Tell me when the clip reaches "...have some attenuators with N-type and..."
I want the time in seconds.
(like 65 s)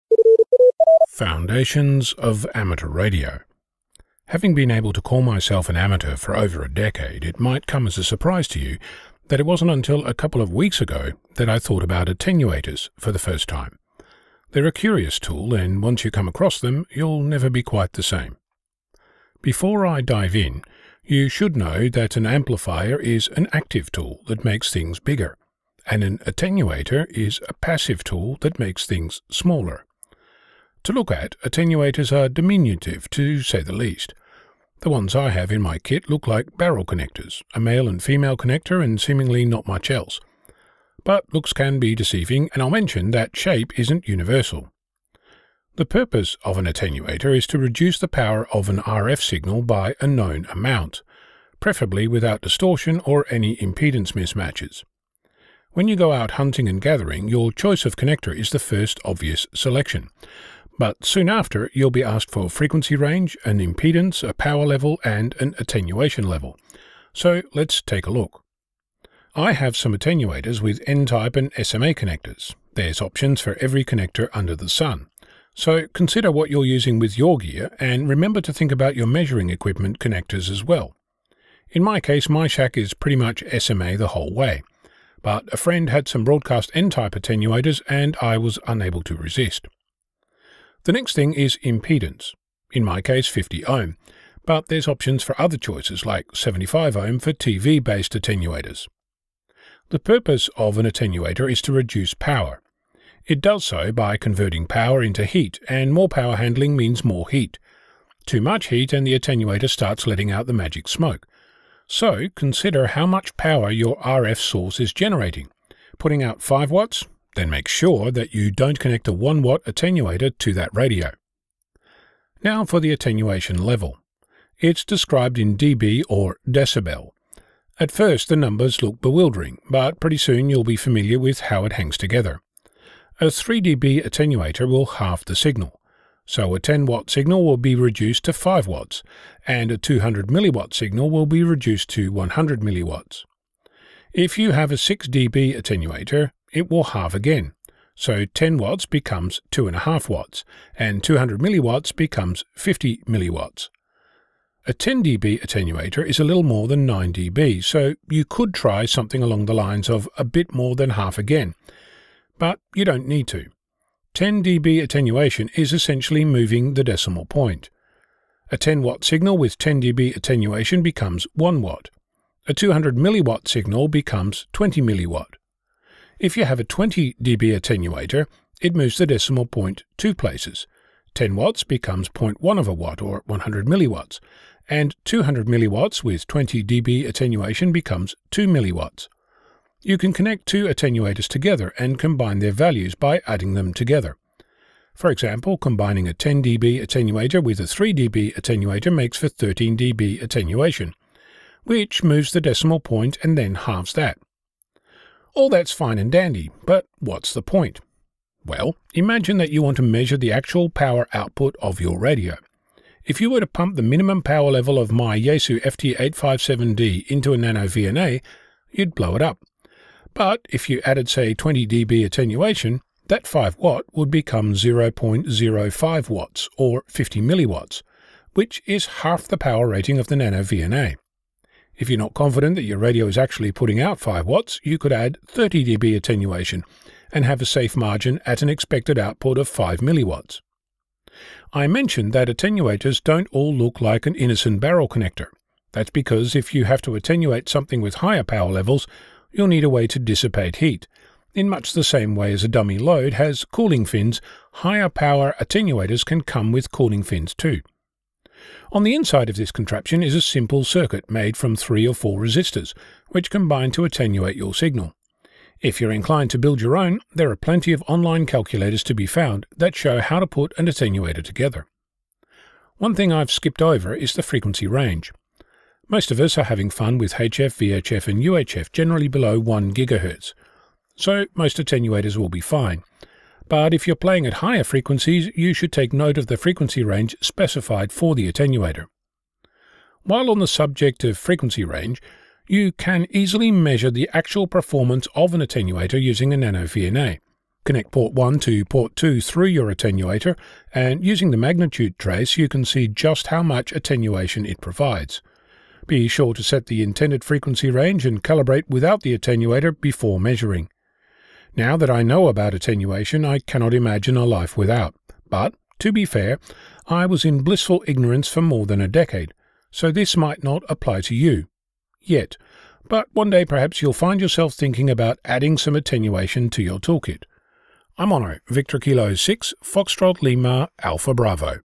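69 s.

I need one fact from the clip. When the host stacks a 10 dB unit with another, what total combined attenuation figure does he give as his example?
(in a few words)
13 dB.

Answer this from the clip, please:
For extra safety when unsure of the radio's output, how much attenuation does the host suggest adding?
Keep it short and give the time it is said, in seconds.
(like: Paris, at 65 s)
30 dB, at 235 s.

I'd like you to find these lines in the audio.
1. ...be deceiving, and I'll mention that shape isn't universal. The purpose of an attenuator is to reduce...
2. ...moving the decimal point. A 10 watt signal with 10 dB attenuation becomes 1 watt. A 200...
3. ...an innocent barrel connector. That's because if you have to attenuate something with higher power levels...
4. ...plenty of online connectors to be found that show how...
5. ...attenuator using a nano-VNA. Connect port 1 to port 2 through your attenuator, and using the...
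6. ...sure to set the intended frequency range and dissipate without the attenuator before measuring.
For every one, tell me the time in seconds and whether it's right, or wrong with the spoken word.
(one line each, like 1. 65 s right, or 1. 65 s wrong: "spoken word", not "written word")
1. 41 s right
2. 166 s right
3. 244 s right
4. 267 s wrong: "calculators", not "connectors"
5. 295 s right
6. 306 s wrong: "calibrate", not "dissipate".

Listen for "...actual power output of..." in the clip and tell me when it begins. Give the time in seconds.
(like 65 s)
210 s.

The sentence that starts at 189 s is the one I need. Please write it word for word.
You can connect two attenuators together and combine their values by adding them together.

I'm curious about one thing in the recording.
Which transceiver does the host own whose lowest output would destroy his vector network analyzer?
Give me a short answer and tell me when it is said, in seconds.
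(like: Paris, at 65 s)
Yaesu FT857D, at 215 s.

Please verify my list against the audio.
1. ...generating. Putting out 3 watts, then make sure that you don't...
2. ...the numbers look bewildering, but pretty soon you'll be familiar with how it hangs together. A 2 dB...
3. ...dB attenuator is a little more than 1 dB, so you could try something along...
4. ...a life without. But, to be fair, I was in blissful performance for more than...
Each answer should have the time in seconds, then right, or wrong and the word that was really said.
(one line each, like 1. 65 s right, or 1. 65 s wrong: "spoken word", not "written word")
1. 114 s wrong: "5", not "3"
2. 128 s wrong: "3", not "2"
3. 155 s wrong: "9", not "1"
4. 314 s wrong: "ignorance", not "performance".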